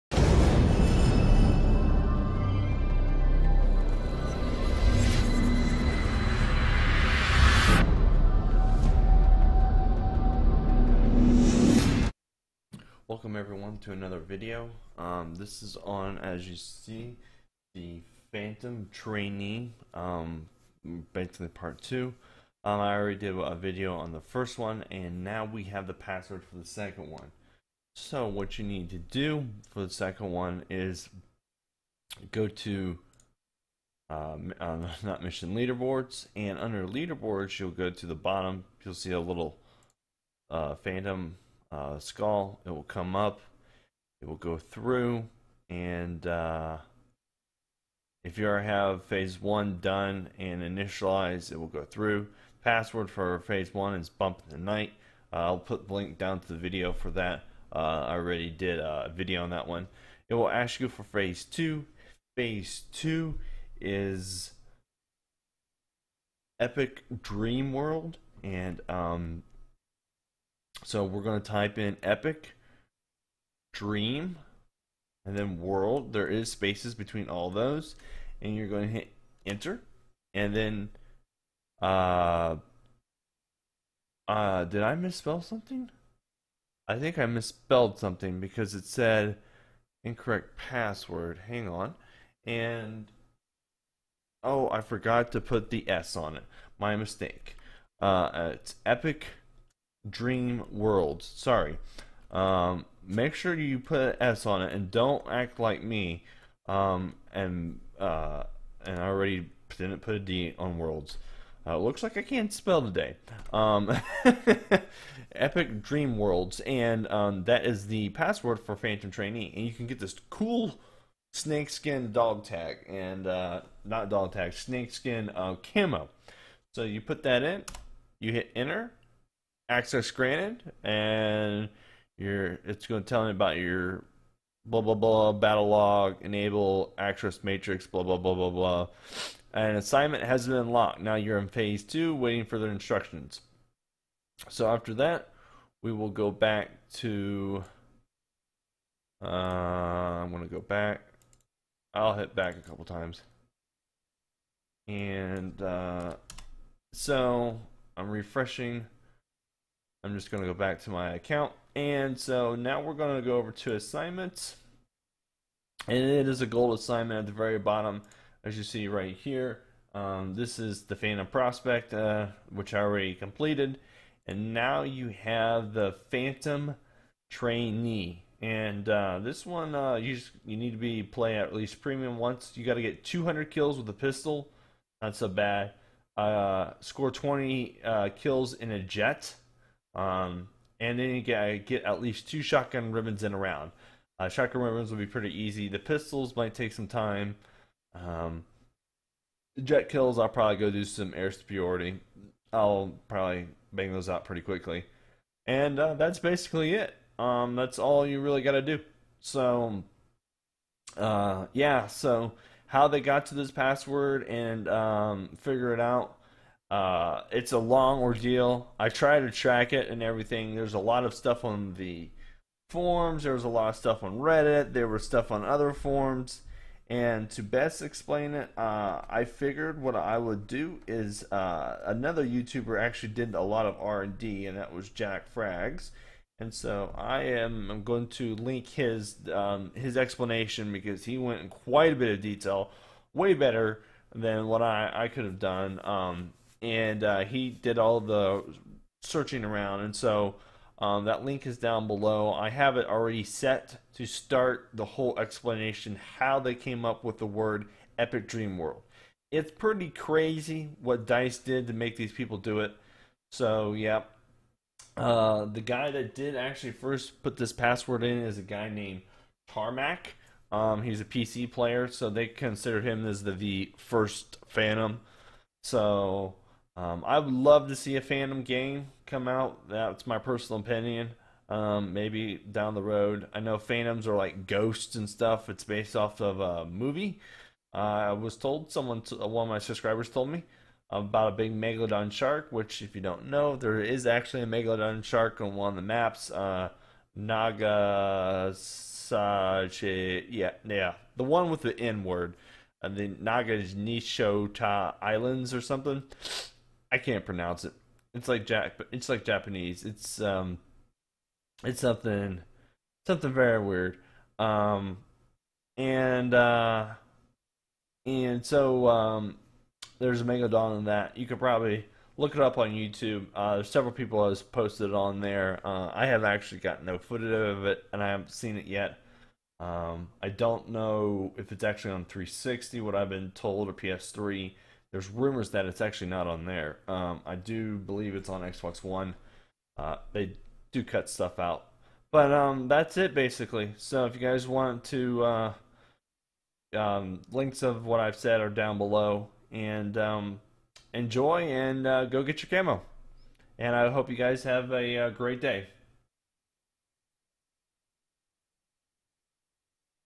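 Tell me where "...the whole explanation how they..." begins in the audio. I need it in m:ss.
4:14.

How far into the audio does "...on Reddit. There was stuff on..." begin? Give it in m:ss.
3:44.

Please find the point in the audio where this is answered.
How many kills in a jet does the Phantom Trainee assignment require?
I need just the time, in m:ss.
3:07.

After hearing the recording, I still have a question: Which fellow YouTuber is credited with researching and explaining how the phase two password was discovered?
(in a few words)
Jackfrags.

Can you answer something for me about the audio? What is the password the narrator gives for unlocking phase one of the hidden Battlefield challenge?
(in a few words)
Bump in the night.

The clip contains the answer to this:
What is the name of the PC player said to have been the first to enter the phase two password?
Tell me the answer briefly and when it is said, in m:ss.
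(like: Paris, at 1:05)
Tarmac, at 4:29.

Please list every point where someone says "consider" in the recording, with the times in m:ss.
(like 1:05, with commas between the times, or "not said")
4:32.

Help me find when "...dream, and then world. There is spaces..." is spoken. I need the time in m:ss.
1:13.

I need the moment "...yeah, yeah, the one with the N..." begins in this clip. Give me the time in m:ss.
4:59.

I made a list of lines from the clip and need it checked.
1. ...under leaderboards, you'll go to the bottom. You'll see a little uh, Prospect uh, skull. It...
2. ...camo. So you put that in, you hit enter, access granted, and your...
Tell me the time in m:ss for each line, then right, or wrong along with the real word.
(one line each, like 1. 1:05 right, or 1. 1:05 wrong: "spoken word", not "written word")
1. 0:36 wrong: "Phantom", not "Prospect"
2. 2:05 right.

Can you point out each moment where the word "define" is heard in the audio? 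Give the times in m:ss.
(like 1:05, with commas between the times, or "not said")
not said.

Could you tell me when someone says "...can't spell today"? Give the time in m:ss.
1:52.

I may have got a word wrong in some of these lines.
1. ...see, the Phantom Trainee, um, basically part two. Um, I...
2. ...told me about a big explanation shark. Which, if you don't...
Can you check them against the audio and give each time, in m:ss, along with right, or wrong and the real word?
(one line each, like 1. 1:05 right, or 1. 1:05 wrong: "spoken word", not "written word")
1. 0:16 right
2. 4:50 wrong: "megalodon", not "explanation".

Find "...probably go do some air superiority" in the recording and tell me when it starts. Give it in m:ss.
3:20.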